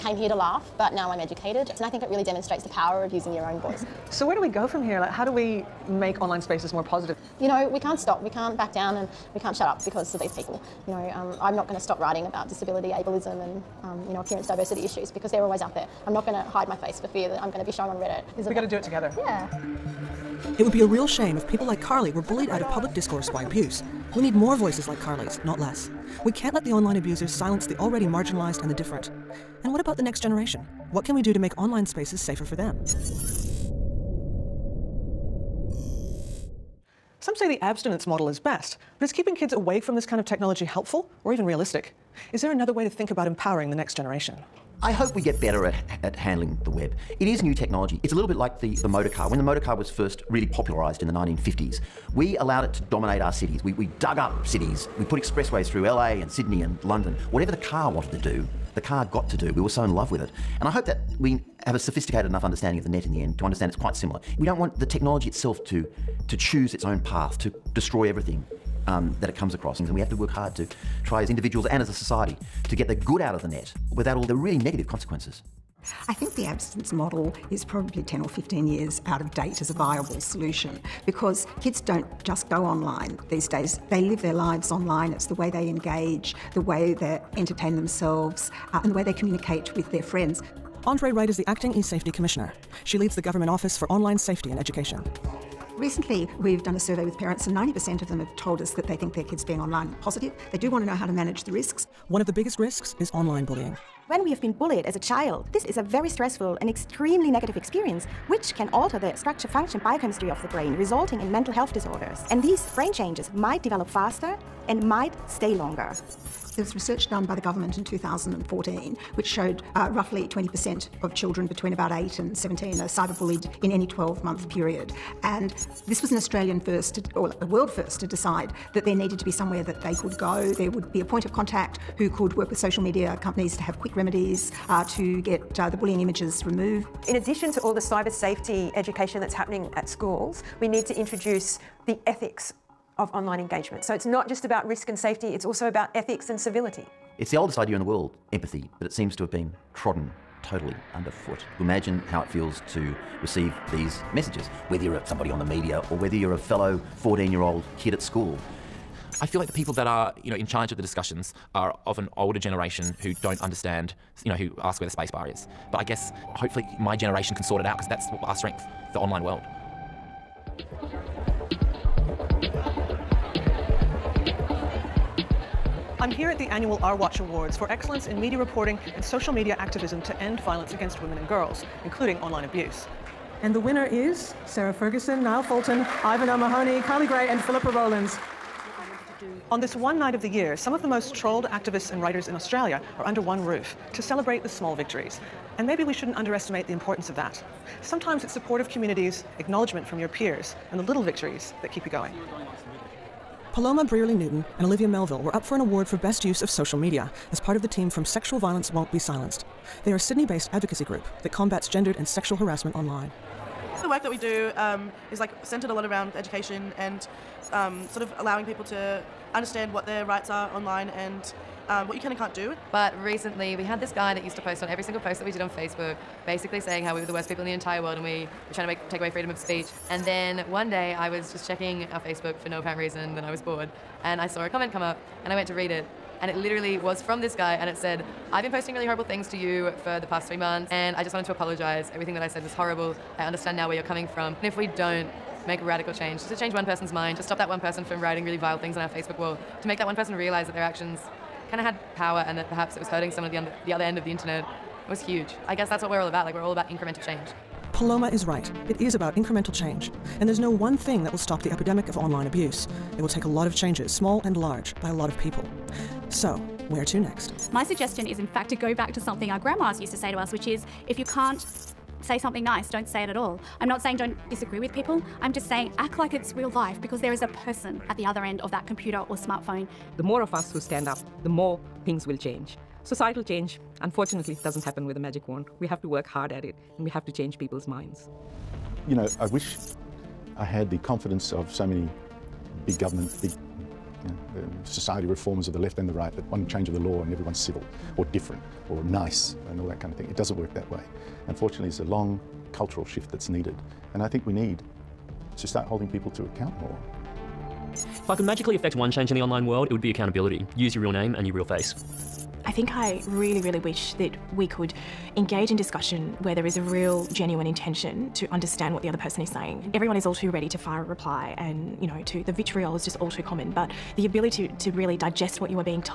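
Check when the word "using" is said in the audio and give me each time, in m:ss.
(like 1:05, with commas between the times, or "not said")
0:03.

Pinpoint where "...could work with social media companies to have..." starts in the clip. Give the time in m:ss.
2:12.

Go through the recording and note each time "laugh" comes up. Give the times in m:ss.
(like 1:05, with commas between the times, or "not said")
0:00.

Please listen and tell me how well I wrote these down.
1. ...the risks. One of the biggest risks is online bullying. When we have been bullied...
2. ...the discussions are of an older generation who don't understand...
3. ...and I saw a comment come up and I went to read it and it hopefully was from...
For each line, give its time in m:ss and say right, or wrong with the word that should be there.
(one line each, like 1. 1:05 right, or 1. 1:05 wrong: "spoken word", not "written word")
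1. 1:41 right
2. 2:40 right
3. 3:54 wrong: "literally", not "hopefully".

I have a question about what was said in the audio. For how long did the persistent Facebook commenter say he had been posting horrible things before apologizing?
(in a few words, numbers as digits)
3 months.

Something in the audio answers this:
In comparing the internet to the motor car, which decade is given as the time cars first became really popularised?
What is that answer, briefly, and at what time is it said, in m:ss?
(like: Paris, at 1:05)
1950s, at 0:51.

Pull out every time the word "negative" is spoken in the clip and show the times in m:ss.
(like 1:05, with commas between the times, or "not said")
1:14, 1:47.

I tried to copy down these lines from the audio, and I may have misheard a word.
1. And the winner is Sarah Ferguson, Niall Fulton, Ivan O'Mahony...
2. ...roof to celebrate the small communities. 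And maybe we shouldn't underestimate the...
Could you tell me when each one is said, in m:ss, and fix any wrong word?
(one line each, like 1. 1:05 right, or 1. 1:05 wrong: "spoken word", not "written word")
1. 3:03 right
2. 3:13 wrong: "victories", not "communities".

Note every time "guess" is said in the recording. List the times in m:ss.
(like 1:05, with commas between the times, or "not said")
2:45, 4:15.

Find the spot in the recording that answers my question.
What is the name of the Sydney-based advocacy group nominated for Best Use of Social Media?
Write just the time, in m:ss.
3:28.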